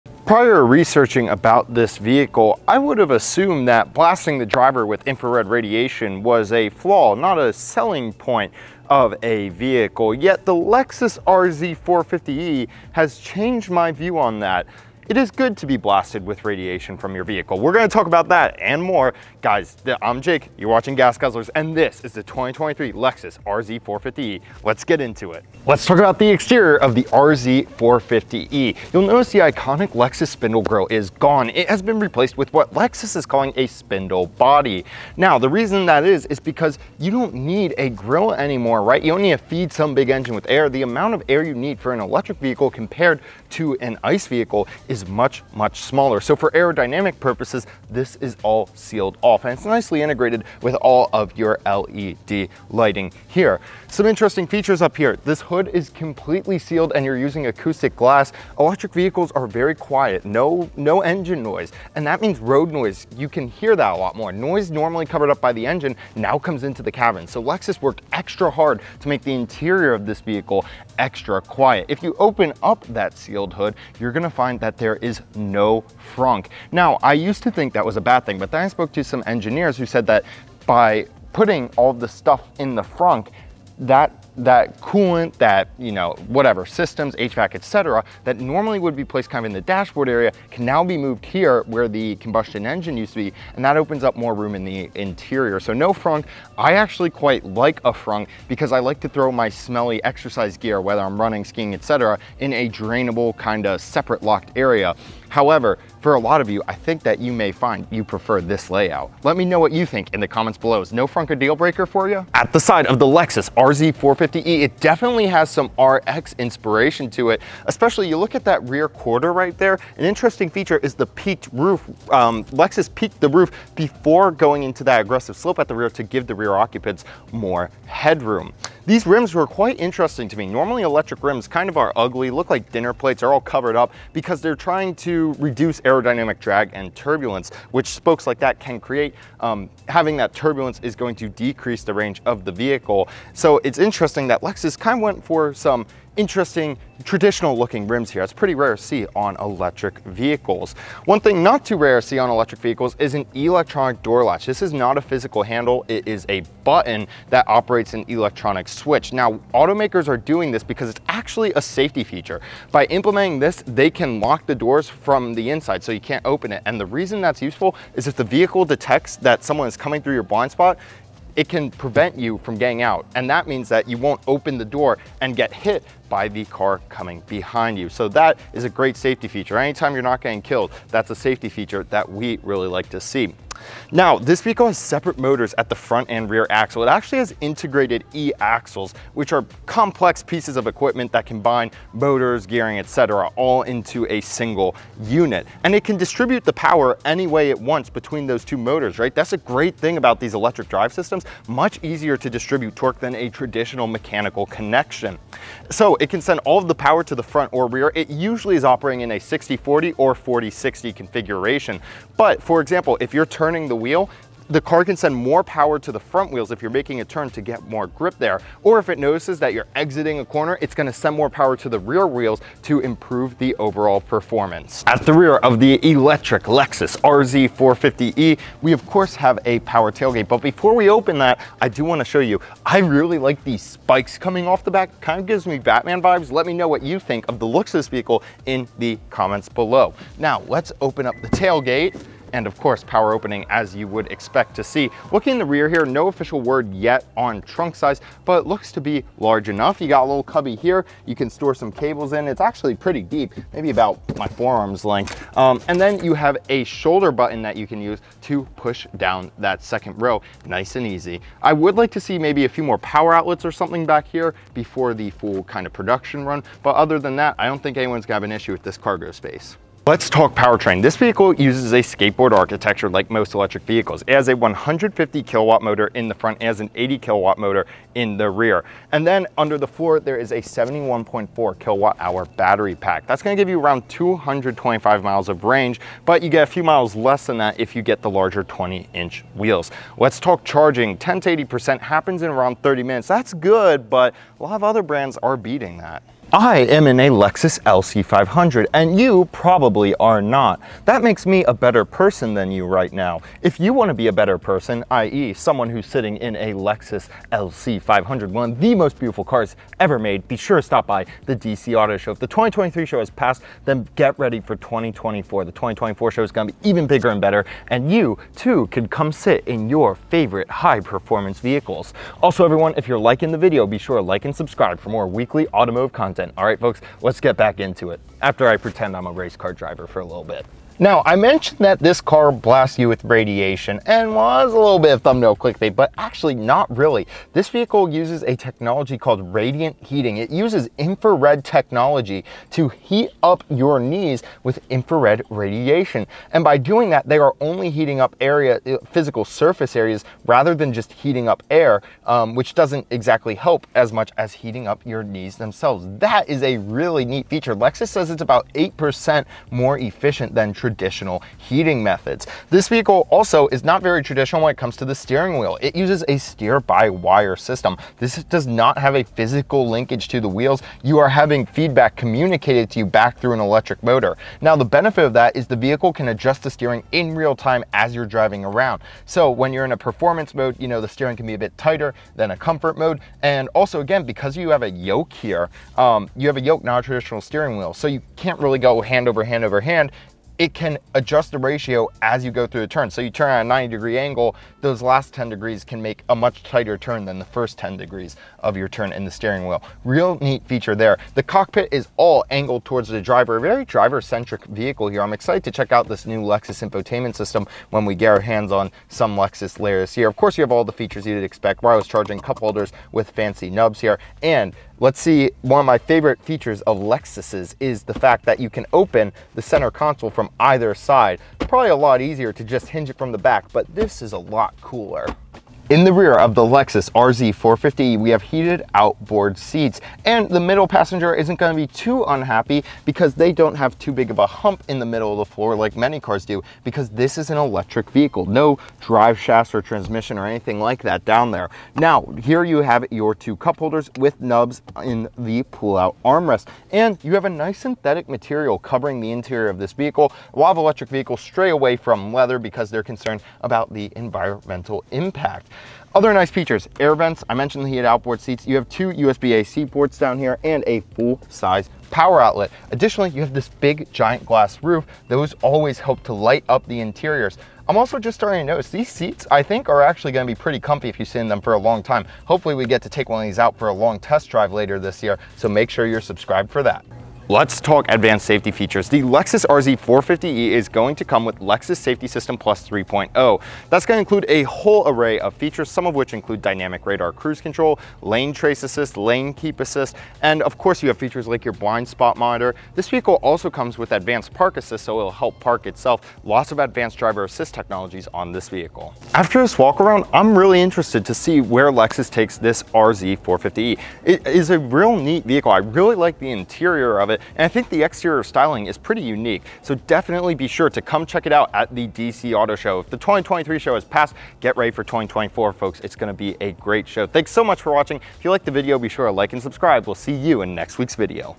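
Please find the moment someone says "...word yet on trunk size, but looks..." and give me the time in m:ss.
4:06.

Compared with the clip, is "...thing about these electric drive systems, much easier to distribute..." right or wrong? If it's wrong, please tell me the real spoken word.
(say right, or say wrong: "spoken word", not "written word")
right.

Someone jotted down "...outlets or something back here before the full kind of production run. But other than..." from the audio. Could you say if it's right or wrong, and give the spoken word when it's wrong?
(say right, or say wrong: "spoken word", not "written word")
right.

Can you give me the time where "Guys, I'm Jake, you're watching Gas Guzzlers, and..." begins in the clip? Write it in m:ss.
0:19.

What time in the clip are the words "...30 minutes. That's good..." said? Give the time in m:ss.
4:52.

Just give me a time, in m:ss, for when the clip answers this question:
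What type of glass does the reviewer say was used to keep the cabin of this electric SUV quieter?
0:57.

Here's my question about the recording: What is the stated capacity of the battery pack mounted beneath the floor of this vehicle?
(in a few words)
71.4 kilowatt hours.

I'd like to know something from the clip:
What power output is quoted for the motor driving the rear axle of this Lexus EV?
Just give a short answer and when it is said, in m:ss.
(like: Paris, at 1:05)
80 kilowatt, at 4:36.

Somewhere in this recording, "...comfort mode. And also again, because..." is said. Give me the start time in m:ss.
6:22.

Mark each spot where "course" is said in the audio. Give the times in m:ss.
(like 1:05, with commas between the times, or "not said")
3:48, 4:02, 6:50, 8:10.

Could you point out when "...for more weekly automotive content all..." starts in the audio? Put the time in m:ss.
5:24.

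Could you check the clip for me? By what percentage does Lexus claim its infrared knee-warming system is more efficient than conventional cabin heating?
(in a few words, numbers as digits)
8%.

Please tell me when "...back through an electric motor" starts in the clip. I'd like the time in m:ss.
6:12.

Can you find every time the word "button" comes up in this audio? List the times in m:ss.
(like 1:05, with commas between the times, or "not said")
2:36, 4:17.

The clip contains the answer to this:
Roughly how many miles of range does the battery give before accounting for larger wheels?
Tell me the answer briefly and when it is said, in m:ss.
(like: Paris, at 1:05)
225 miles, at 4:43.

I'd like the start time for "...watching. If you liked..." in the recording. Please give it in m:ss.
8:37.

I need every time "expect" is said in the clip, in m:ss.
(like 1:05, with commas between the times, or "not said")
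4:04, 6:51.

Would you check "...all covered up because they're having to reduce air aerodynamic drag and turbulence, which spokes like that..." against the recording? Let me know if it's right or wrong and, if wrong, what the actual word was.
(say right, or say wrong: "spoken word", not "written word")
wrong: "trying", not "having".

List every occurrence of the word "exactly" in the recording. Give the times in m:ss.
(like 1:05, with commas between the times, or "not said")
5:52.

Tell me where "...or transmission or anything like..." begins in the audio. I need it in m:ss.
7:19.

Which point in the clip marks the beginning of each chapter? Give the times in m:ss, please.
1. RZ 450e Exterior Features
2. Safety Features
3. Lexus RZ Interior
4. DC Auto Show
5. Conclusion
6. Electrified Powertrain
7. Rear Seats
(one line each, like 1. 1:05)
1. 0:26
2. 7:57
3. 5:30
4. 4:55
5. 8:18
6. 4:30
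7. 7:05.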